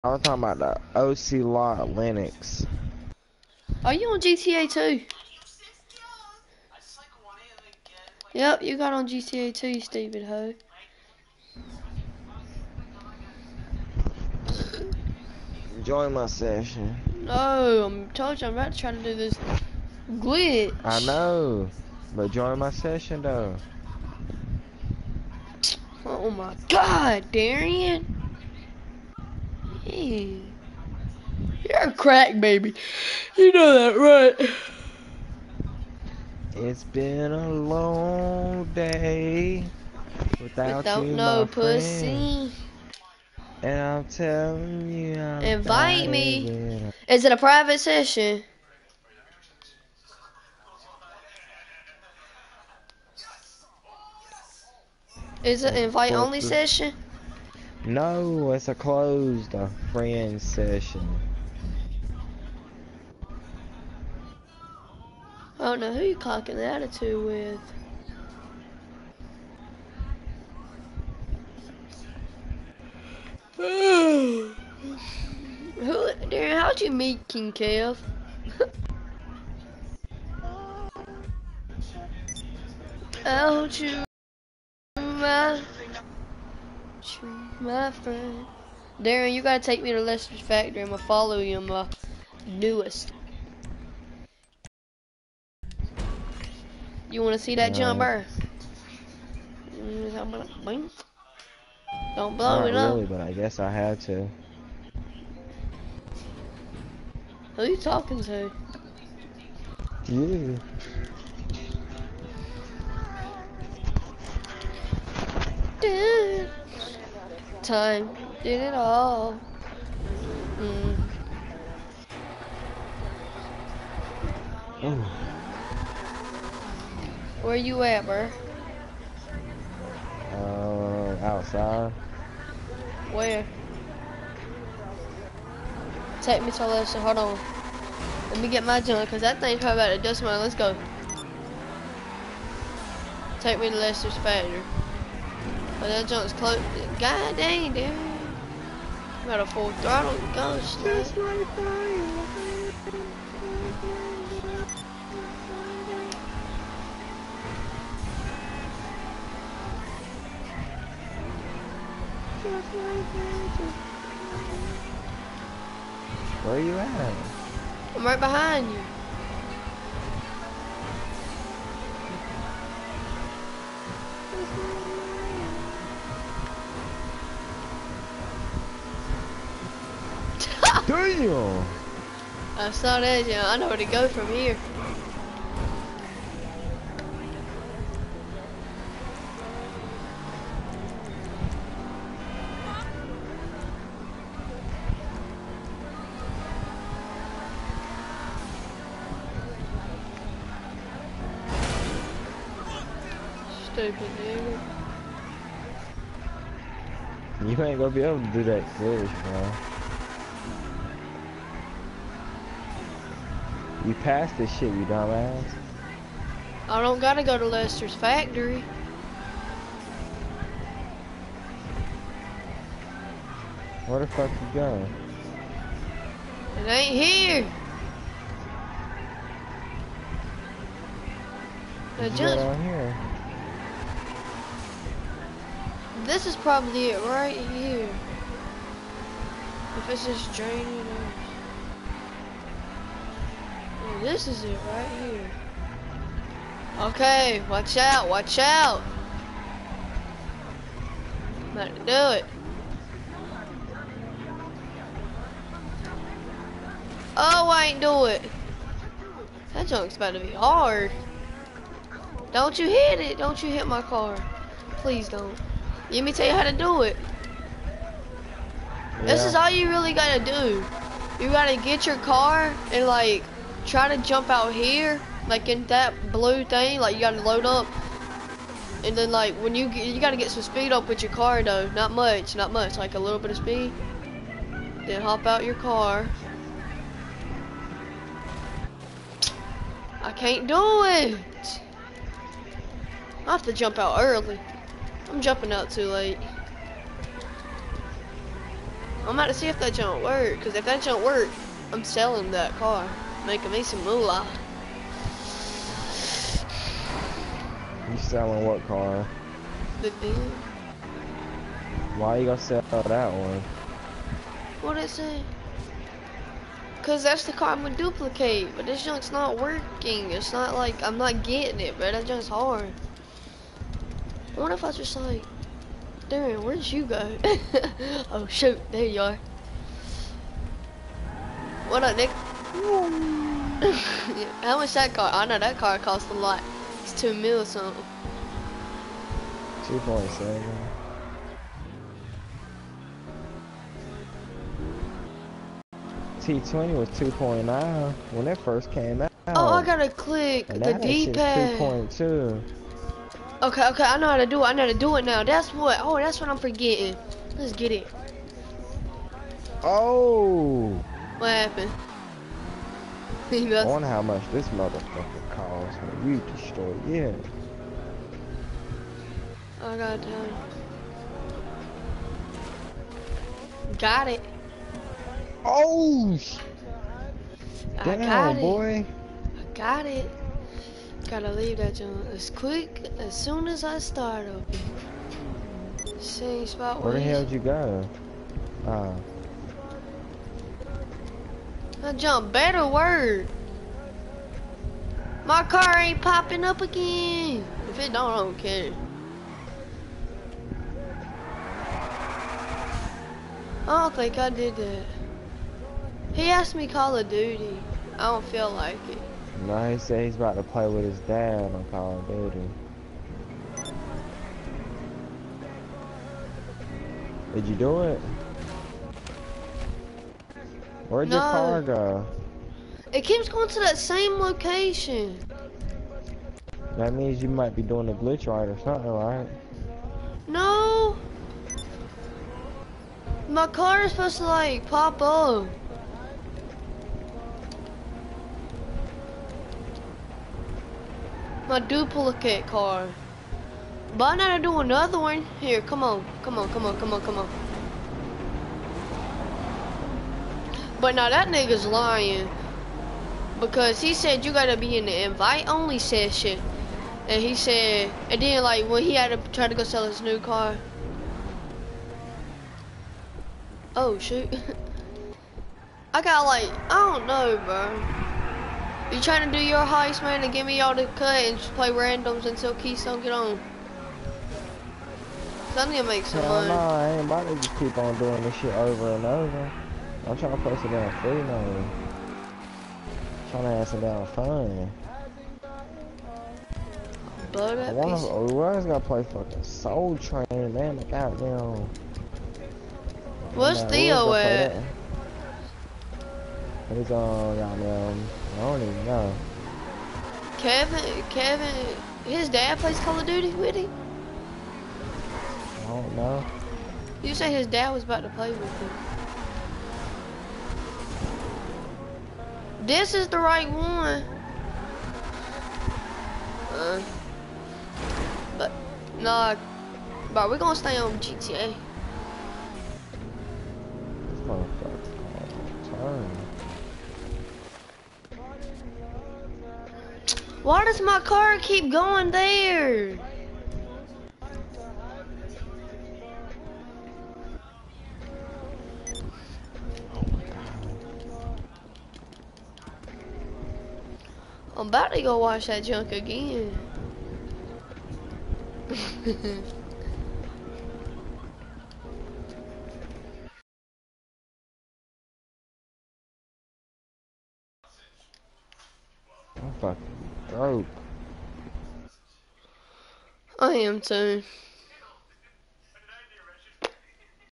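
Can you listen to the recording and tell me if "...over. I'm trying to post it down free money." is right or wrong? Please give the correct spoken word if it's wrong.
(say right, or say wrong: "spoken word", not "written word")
right.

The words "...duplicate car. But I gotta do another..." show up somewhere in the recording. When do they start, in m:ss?
7:21.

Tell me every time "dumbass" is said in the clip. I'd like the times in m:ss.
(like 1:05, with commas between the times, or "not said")
3:34.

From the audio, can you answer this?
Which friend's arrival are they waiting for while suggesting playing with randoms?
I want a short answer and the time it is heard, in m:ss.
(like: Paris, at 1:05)
Keystone, at 7:52.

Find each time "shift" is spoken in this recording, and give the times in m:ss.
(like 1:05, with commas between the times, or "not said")
not said.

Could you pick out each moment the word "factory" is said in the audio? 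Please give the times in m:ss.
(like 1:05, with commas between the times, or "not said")
1:30, 2:24, 3:37.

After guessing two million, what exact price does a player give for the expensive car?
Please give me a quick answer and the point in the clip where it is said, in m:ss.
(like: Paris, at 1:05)
2.7, at 5:39.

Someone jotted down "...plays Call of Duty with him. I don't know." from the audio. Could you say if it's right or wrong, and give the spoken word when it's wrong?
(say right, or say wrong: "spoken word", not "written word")
right.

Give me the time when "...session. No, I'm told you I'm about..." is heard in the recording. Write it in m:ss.
0:16.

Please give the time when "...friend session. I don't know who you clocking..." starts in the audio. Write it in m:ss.
0:59.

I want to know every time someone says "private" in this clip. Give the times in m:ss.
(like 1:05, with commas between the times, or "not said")
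0:47.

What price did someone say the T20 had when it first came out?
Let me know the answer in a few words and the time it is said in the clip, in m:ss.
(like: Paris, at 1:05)
2.9, at 5:46.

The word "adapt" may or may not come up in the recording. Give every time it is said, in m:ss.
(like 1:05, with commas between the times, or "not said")
not said.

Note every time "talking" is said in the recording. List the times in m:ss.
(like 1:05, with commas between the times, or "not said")
0:00, 1:47.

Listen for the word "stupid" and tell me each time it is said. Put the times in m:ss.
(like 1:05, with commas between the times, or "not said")
0:09, 3:23.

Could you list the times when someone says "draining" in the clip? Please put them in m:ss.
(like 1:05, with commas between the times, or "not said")
4:00.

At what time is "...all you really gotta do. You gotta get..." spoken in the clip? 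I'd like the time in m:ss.
4:29.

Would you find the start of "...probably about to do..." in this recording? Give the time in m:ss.
2:19.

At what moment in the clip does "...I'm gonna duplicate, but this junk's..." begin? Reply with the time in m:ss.
5:17.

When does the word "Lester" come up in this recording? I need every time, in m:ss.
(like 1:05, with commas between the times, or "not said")
1:30, 2:16, 2:23, 3:37.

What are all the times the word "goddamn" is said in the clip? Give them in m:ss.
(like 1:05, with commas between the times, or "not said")
8:10, 8:17.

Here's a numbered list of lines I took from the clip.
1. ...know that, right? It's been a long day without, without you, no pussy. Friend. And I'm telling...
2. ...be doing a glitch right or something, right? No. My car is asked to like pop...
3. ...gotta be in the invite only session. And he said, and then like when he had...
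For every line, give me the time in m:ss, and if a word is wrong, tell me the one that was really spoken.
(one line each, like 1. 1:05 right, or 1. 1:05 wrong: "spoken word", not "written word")
1. 0:33 right
2. 7:07 wrong: "supposed", not "asked"
3. 7:34 right.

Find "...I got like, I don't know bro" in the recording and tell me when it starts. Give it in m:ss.
7:45.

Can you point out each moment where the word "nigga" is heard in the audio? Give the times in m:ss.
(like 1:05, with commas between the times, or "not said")
3:24, 7:31.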